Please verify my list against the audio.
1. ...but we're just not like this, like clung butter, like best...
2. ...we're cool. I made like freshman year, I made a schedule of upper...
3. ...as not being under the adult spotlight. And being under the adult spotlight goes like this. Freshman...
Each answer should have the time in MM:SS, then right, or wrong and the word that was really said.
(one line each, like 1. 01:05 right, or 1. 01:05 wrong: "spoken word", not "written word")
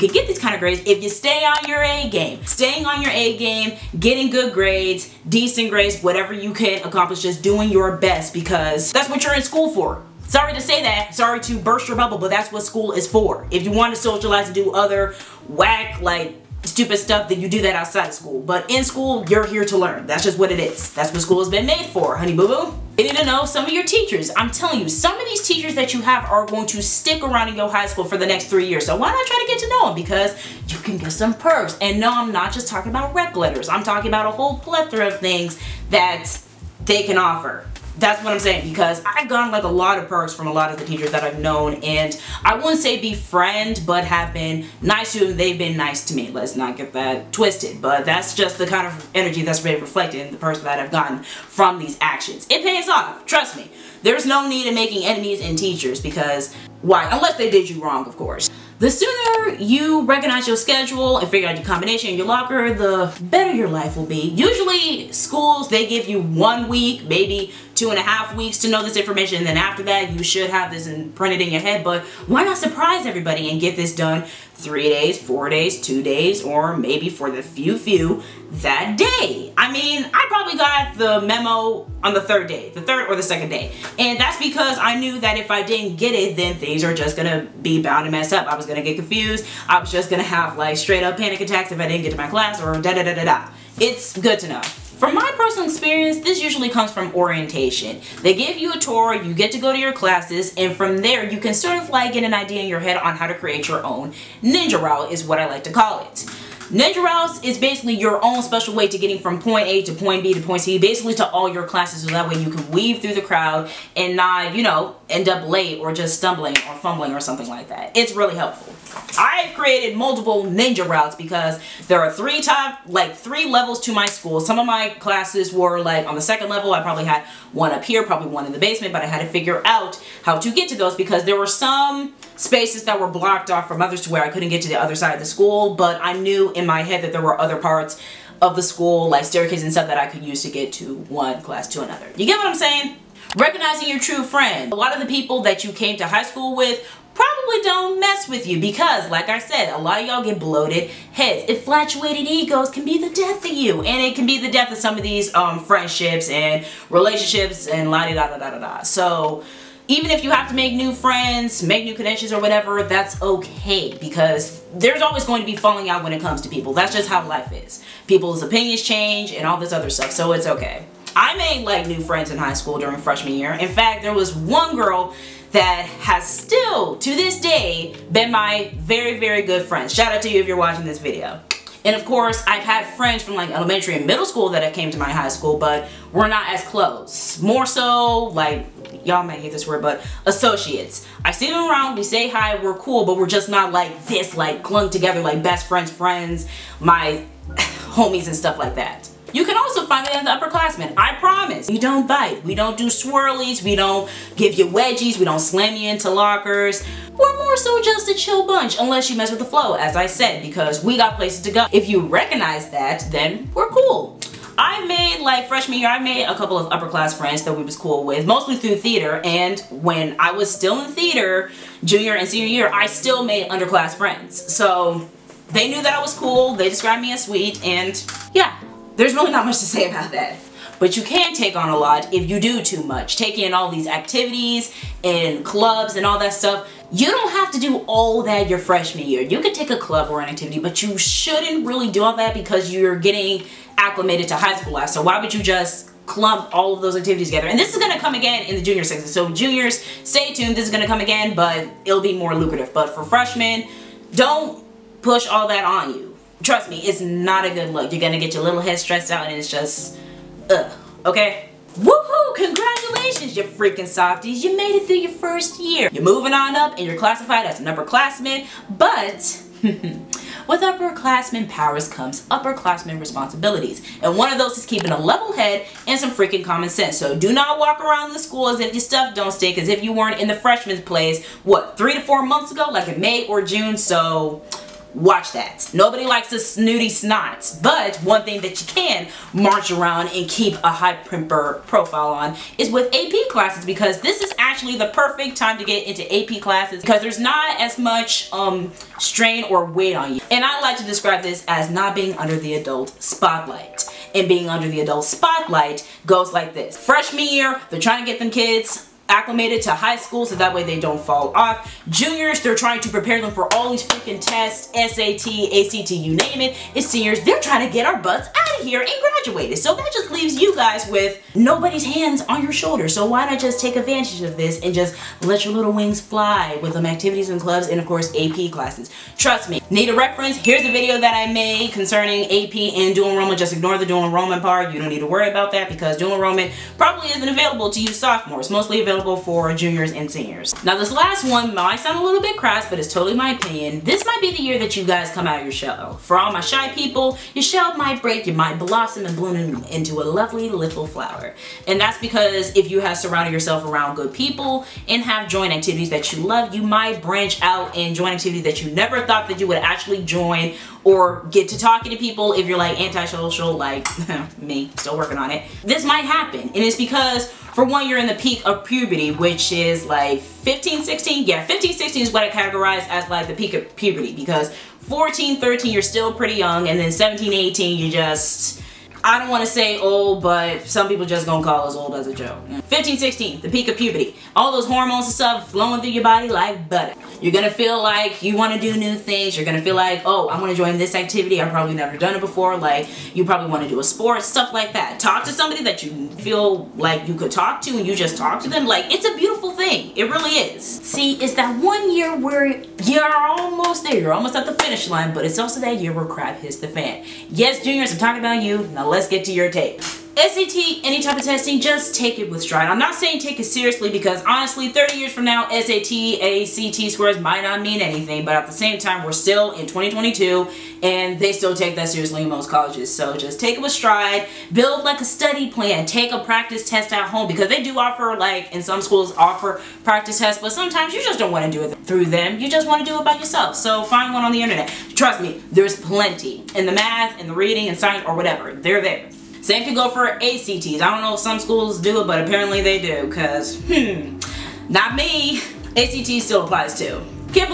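1. 03:13 wrong: "together", not "butter"
2. 03:33 wrong: "couple", not "schedule"
3. 05:01 right.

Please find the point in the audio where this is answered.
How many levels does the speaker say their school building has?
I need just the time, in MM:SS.
02:03.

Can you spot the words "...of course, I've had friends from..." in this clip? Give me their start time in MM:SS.
03:01.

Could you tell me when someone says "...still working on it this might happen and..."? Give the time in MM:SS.
06:04.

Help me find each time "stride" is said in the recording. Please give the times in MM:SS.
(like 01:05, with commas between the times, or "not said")
06:52, 07:03.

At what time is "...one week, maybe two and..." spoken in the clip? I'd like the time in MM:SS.
01:06.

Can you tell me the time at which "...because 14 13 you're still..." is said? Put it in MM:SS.
06:14.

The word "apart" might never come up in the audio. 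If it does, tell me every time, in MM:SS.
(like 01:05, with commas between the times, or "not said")
not said.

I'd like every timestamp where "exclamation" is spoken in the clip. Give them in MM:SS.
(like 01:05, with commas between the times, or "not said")
not said.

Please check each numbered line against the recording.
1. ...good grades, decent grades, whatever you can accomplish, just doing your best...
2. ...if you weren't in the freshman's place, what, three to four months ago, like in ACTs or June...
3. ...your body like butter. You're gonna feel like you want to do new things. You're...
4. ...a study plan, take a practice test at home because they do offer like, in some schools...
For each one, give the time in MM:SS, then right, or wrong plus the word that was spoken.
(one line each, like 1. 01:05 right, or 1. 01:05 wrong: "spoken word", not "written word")
1. 00:04 right
2. 04:39 wrong: "May", not "ACTs"
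3. 06:25 right
4. 07:04 right.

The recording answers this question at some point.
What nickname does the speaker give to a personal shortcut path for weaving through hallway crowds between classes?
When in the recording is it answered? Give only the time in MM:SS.
01:44.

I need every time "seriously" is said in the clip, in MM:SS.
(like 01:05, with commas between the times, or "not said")
06:53, 07:01.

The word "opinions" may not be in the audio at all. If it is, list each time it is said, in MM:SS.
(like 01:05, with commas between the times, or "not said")
02:48, 05:43.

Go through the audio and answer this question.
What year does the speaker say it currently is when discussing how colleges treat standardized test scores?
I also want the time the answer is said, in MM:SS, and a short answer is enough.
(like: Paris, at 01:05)
2022, at 06:59.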